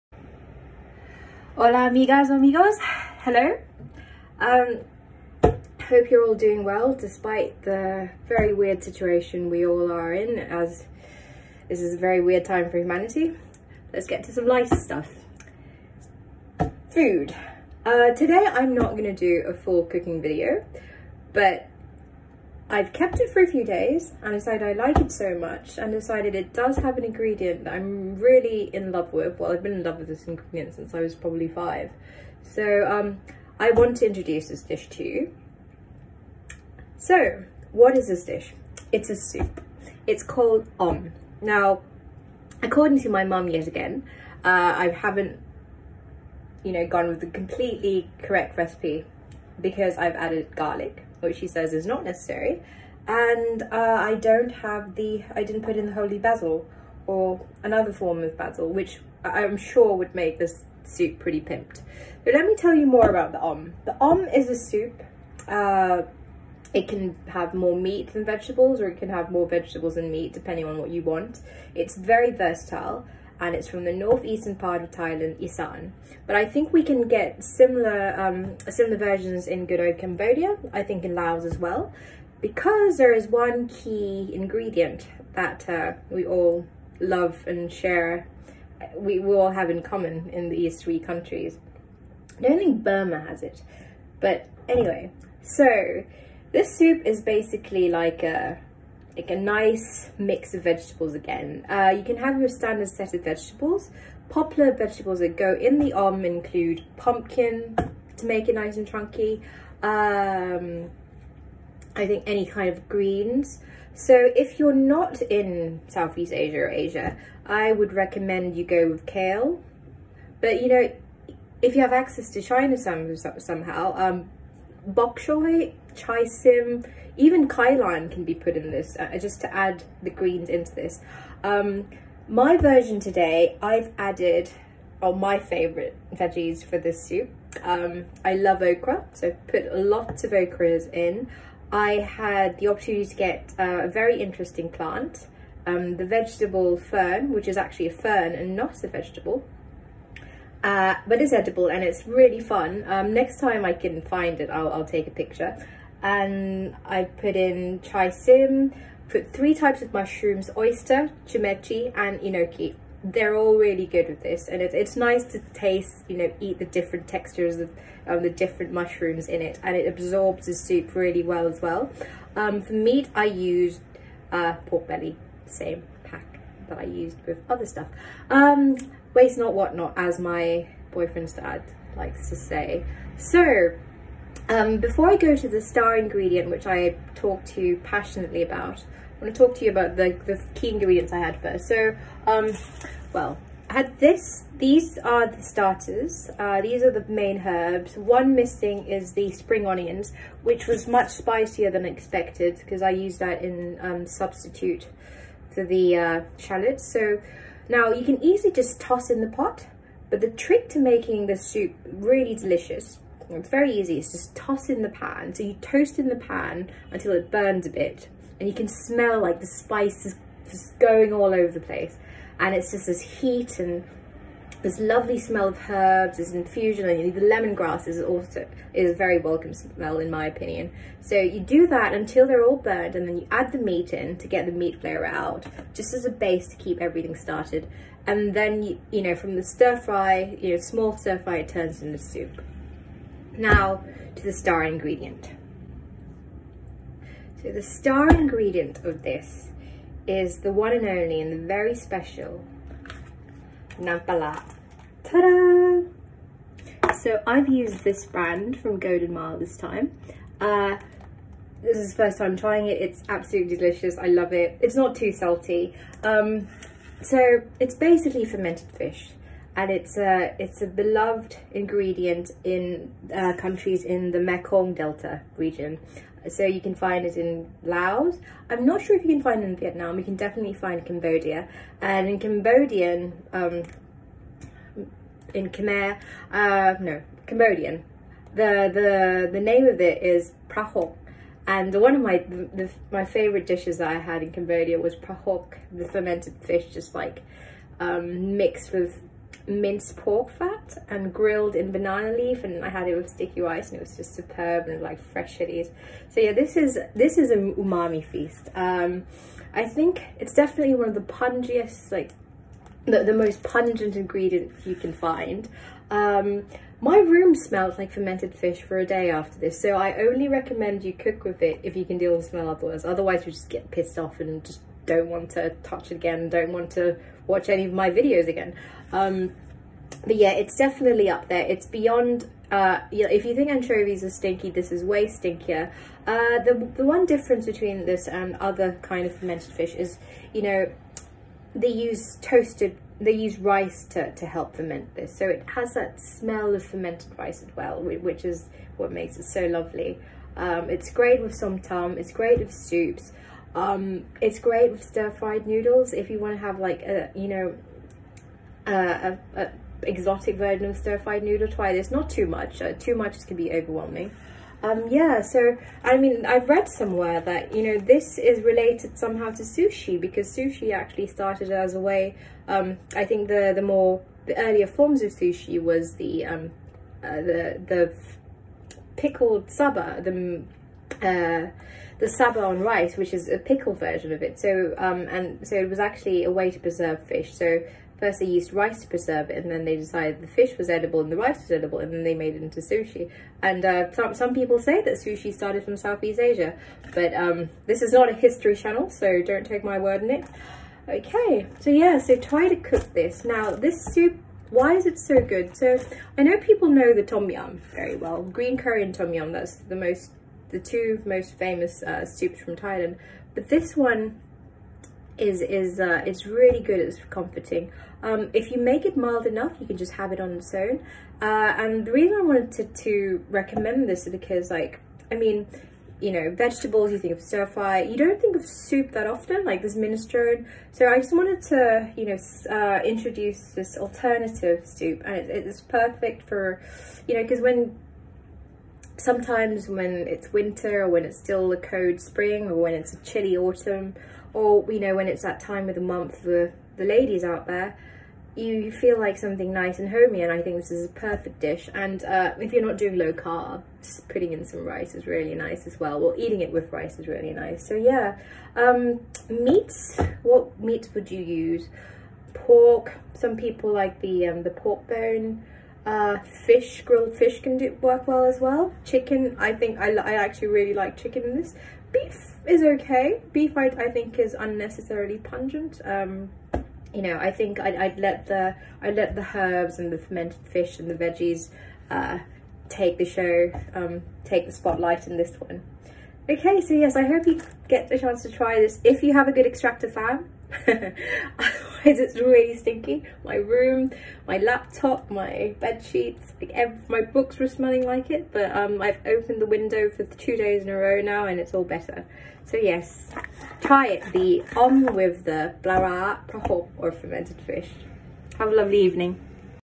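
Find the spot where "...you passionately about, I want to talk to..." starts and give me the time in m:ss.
3:07.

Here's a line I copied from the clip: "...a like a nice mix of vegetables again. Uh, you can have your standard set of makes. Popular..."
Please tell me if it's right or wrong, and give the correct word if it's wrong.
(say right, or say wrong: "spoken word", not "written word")
wrong: "vegetables", not "makes".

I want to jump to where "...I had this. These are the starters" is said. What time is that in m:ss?
3:13.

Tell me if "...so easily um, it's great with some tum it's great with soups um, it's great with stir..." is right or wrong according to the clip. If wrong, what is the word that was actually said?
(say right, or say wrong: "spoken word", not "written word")
wrong: "lovely", not "easily".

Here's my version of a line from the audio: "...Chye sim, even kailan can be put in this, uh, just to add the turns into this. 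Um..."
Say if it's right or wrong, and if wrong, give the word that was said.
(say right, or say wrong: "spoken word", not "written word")
wrong: "greens", not "turns".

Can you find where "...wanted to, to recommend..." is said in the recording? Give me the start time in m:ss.
7:02.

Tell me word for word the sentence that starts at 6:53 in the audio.
But this one is is uh, it's really good.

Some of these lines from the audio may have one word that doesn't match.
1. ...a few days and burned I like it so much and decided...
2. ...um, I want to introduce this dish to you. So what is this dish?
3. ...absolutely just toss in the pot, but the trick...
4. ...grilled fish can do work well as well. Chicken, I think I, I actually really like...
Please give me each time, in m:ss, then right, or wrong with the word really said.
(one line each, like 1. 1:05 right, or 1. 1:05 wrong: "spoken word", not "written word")
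1. 0:23 wrong: "decided", not "burned"
2. 0:32 right
3. 3:28 wrong: "easily", not "absolutely"
4. 7:46 right.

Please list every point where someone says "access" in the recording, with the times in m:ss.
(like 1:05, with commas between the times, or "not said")
2:01.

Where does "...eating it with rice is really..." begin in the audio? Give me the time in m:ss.
7:36.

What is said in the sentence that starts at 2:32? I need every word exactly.
Um, next time I can find it, I'll, I'll take a picture.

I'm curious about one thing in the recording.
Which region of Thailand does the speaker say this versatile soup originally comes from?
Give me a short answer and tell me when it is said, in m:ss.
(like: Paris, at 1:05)
Isaan, at 1:15.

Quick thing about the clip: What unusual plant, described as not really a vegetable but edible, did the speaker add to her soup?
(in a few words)
vegetable fern.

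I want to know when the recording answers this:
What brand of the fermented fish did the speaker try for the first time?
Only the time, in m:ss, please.
4:18.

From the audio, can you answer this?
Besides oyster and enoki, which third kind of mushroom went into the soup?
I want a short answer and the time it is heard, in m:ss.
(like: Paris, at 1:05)
shimeji, at 2:41.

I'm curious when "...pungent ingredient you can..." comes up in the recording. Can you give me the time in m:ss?
5:13.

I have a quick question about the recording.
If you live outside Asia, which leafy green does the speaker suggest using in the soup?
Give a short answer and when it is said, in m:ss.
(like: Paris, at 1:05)
kale, at 1:59.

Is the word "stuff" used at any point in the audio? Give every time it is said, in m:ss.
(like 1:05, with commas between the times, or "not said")
0:14, 2:57.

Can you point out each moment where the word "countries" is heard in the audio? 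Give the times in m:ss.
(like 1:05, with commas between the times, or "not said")
1:30, 4:33.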